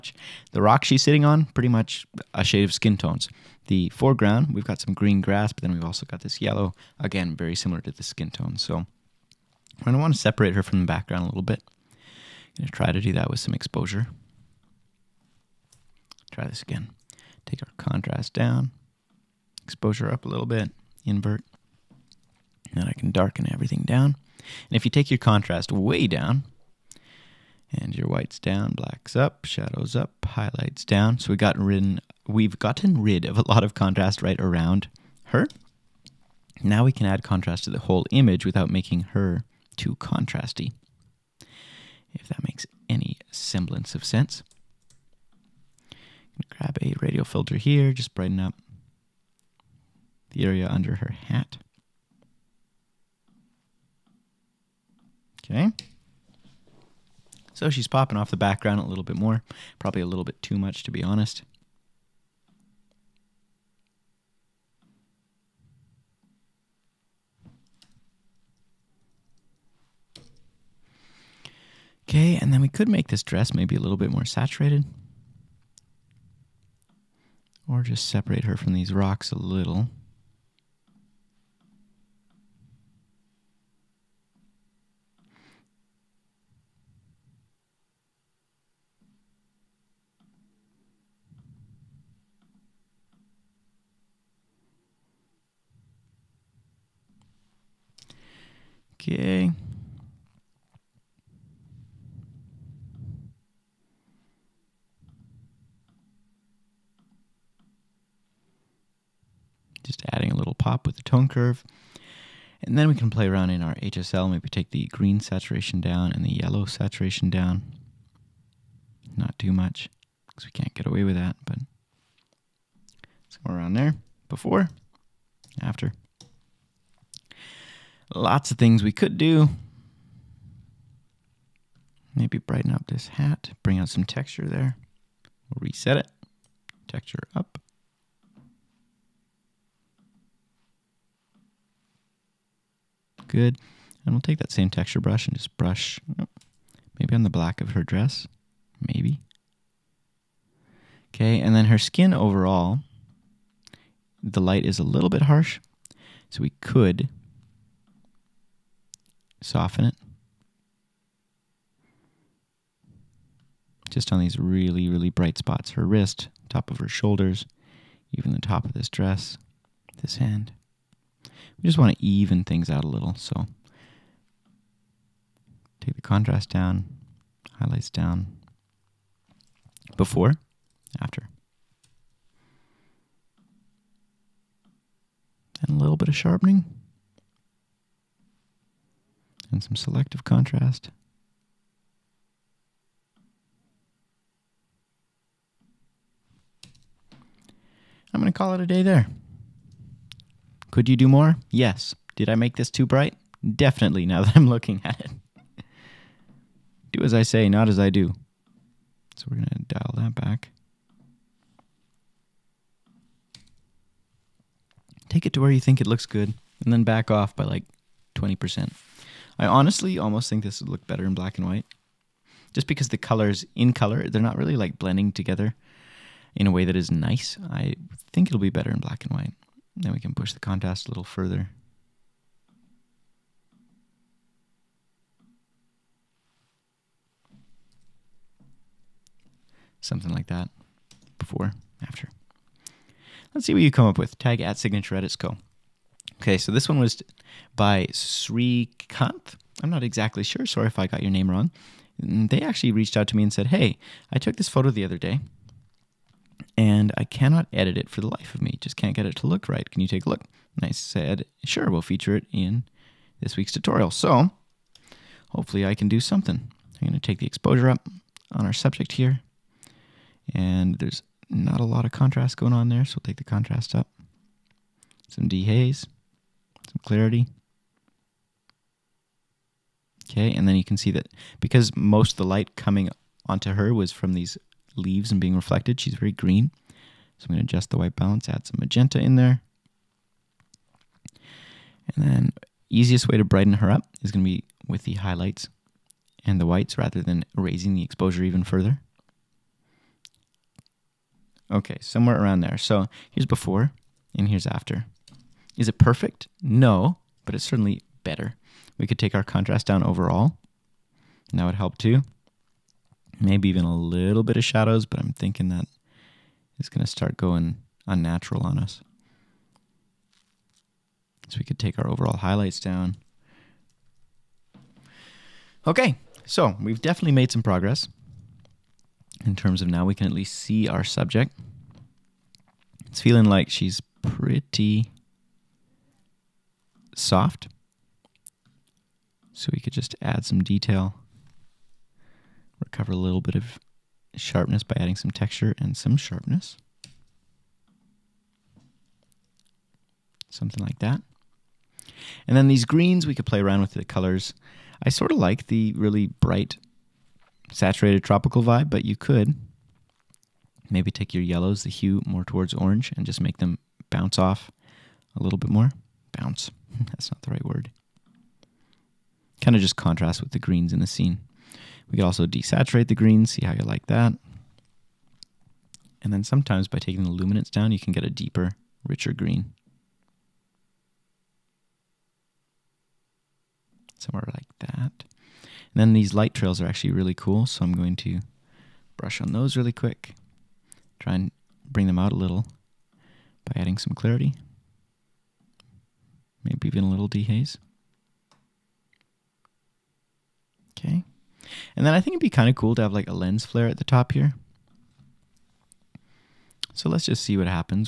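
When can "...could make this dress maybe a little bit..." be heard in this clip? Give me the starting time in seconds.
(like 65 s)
72 s.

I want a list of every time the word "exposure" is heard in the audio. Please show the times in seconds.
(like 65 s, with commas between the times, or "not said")
13 s, 19 s, 267 s, 297 s.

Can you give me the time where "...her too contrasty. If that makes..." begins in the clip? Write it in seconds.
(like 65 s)
39 s.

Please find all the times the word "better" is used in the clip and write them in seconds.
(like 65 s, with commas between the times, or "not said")
220 s, 228 s, 308 s.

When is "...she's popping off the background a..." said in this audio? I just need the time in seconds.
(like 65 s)
57 s.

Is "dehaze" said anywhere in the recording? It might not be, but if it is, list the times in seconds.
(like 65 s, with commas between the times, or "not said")
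275 s, 397 s.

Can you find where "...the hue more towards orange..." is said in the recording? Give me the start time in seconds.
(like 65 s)
361 s.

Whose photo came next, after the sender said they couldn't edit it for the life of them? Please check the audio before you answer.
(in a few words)
Srikanth.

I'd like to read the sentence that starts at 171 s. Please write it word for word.
We just want to even things out a little, so take the contrast down, highlights down, before, after.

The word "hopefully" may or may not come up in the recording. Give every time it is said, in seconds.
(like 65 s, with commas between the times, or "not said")
265 s.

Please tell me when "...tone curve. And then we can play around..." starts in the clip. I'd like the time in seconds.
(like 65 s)
111 s.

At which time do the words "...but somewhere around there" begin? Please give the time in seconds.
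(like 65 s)
121 s.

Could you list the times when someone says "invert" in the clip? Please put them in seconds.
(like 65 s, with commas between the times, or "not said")
21 s.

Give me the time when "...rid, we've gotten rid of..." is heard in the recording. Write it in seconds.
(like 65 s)
31 s.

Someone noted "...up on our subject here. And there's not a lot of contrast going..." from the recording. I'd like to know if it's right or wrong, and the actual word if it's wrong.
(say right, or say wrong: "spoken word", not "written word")
right.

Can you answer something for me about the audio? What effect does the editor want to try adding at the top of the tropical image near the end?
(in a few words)
Lens flare.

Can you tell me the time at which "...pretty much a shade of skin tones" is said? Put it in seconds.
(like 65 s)
1 s.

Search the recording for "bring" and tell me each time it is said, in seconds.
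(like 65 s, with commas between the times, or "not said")
133 s, 391 s.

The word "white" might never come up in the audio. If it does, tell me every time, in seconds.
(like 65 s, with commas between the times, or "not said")
28 s, 221 s, 229 s, 287 s, 296 s.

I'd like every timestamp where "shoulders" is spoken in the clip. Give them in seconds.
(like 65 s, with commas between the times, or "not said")
166 s.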